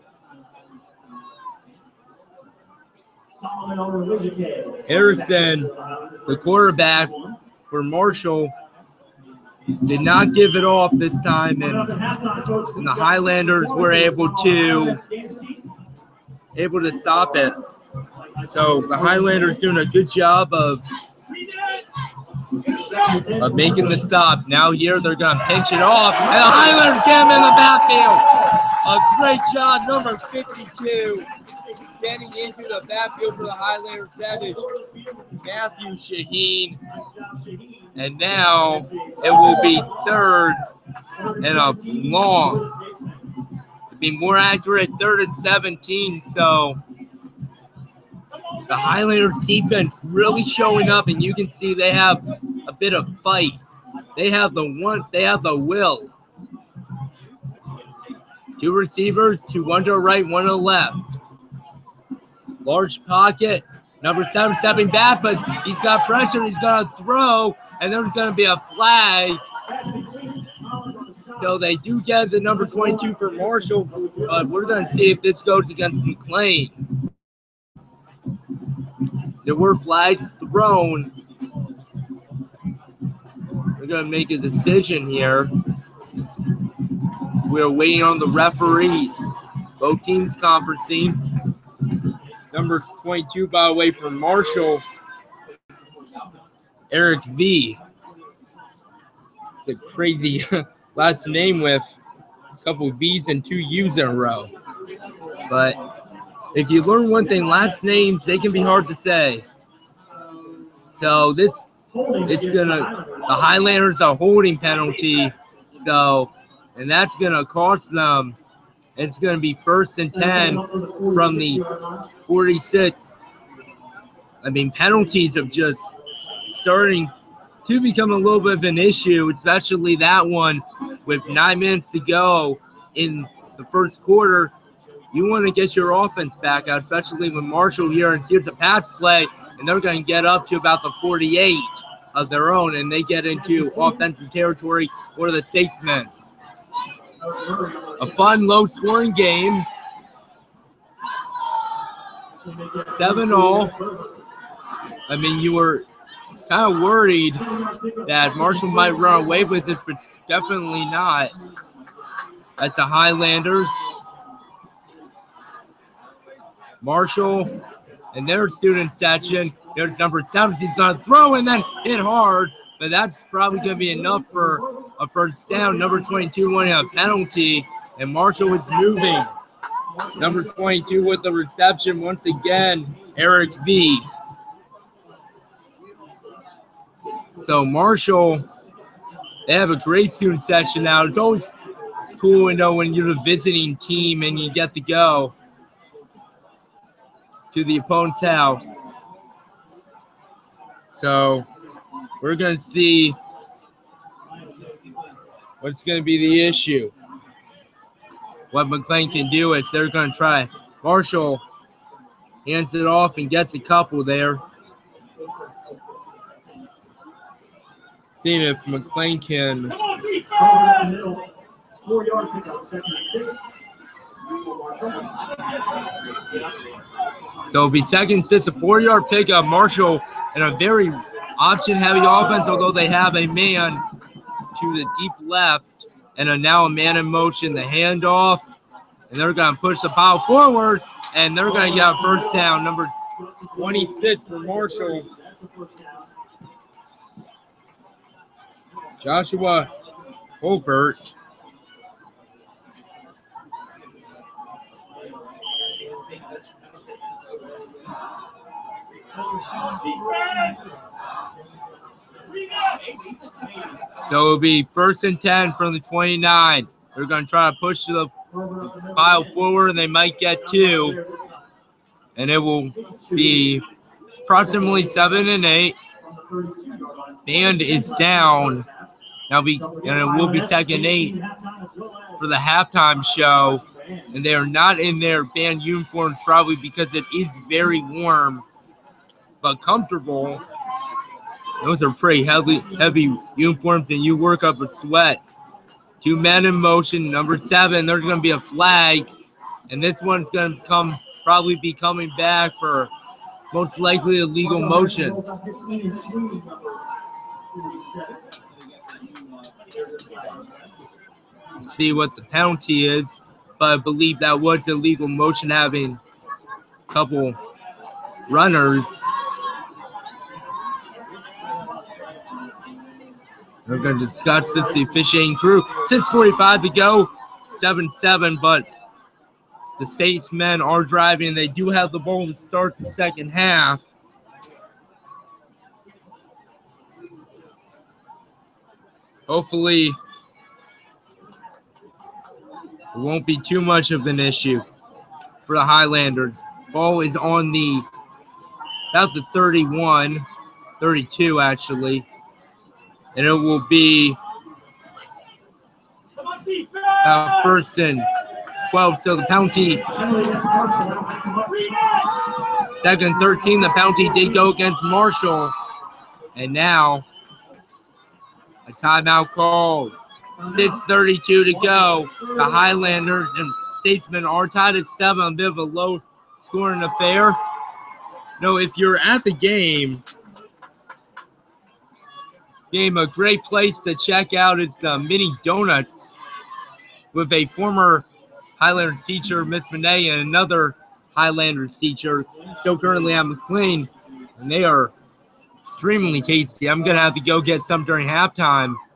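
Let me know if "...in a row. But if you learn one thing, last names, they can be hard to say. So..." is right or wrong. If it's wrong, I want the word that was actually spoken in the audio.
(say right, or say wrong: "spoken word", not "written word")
right.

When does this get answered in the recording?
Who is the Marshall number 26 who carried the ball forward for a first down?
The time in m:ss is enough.
4:09.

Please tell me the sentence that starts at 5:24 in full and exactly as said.
The officiating crew, 6:45 to go, 7-7.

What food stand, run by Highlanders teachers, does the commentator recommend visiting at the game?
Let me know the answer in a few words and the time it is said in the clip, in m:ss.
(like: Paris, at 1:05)
Mini Donuts, at 6:24.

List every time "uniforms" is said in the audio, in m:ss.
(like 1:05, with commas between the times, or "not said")
4:45, 4:53.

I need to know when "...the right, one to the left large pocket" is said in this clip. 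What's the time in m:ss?
0:59.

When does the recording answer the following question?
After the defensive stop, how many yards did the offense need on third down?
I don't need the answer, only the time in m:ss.
0:44.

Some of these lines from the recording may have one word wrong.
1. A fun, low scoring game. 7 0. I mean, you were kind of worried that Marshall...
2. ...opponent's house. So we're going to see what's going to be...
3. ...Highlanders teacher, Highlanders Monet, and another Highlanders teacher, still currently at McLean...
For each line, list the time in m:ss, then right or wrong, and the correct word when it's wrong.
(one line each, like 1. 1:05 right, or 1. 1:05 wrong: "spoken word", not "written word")
1. 2:28 right
2. 3:17 right
3. 6:28 wrong: "Miss", not "Highlanders".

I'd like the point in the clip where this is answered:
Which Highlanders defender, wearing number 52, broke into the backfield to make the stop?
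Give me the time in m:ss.
0:35.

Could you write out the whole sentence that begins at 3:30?
Marshall hands it off and gets a couple there.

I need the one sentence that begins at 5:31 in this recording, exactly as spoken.
They do have the ball to start the second half.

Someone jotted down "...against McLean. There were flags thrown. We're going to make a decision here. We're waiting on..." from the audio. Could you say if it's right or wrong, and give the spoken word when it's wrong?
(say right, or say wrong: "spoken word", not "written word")
right.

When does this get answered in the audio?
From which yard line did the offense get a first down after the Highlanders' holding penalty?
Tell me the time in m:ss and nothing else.
1:59.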